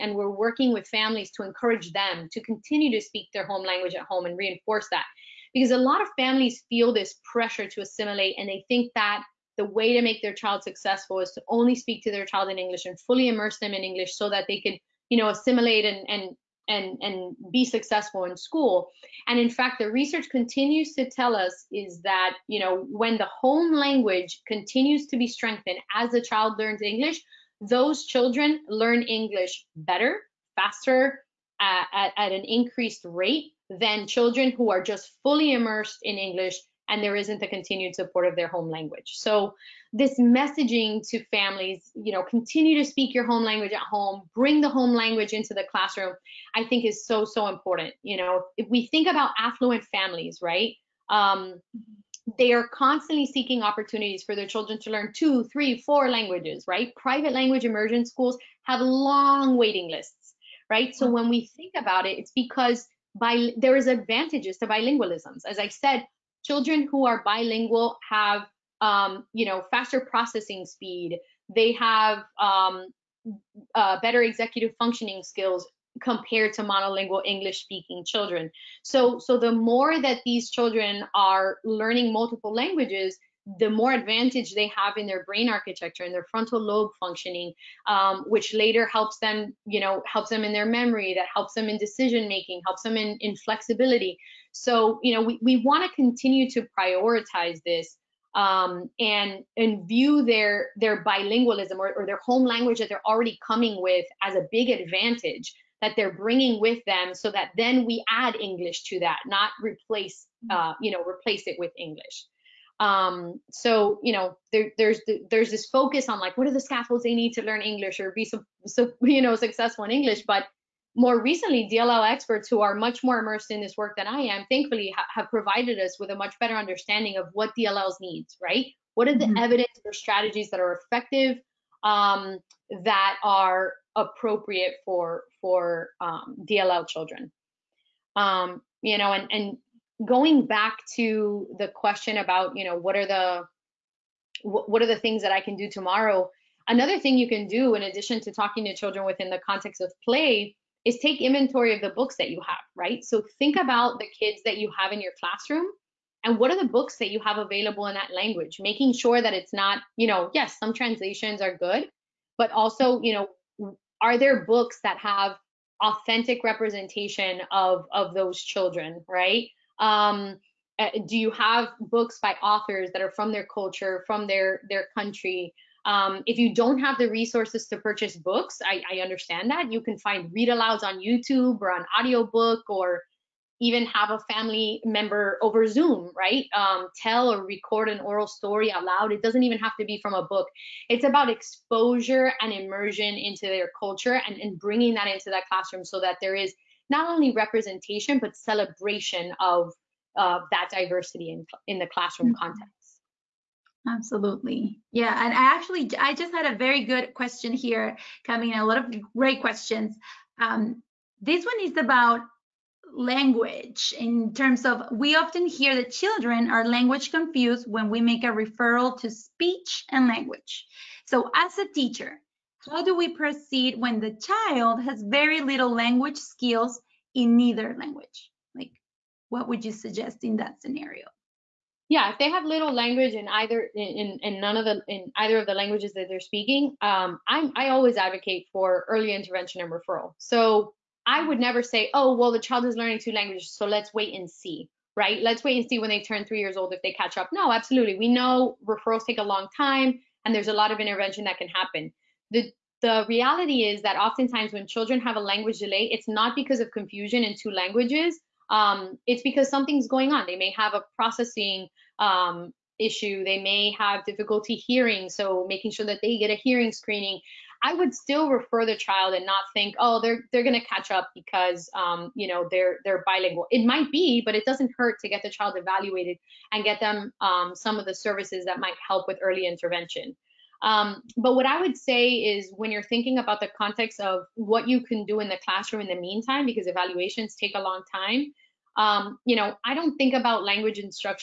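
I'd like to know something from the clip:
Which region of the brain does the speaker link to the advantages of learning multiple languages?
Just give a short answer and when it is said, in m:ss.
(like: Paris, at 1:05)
frontal lobe, at 1:26.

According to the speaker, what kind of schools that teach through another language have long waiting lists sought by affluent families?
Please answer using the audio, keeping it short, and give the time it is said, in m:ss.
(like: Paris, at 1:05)
Private language immersion schools, at 0:56.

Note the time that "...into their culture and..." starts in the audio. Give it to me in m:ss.
3:13.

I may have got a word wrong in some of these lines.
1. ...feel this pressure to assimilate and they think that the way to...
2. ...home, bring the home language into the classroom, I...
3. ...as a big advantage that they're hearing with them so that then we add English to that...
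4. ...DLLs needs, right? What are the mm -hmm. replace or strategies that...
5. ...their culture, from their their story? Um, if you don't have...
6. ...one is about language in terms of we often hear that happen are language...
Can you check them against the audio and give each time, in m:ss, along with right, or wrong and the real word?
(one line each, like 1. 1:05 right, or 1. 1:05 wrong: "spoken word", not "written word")
1. 0:06 right
2. 0:43 right
3. 1:44 wrong: "bringing", not "hearing"
4. 2:07 wrong: "evidence", not "replace"
5. 2:53 wrong: "country", not "story"
6. 3:31 wrong: "children", not "happen".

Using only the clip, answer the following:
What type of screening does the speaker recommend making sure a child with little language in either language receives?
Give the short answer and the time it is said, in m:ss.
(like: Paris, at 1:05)
hearing screening, at 4:26.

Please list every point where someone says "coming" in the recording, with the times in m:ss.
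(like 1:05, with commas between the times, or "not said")
1:43, 3:28.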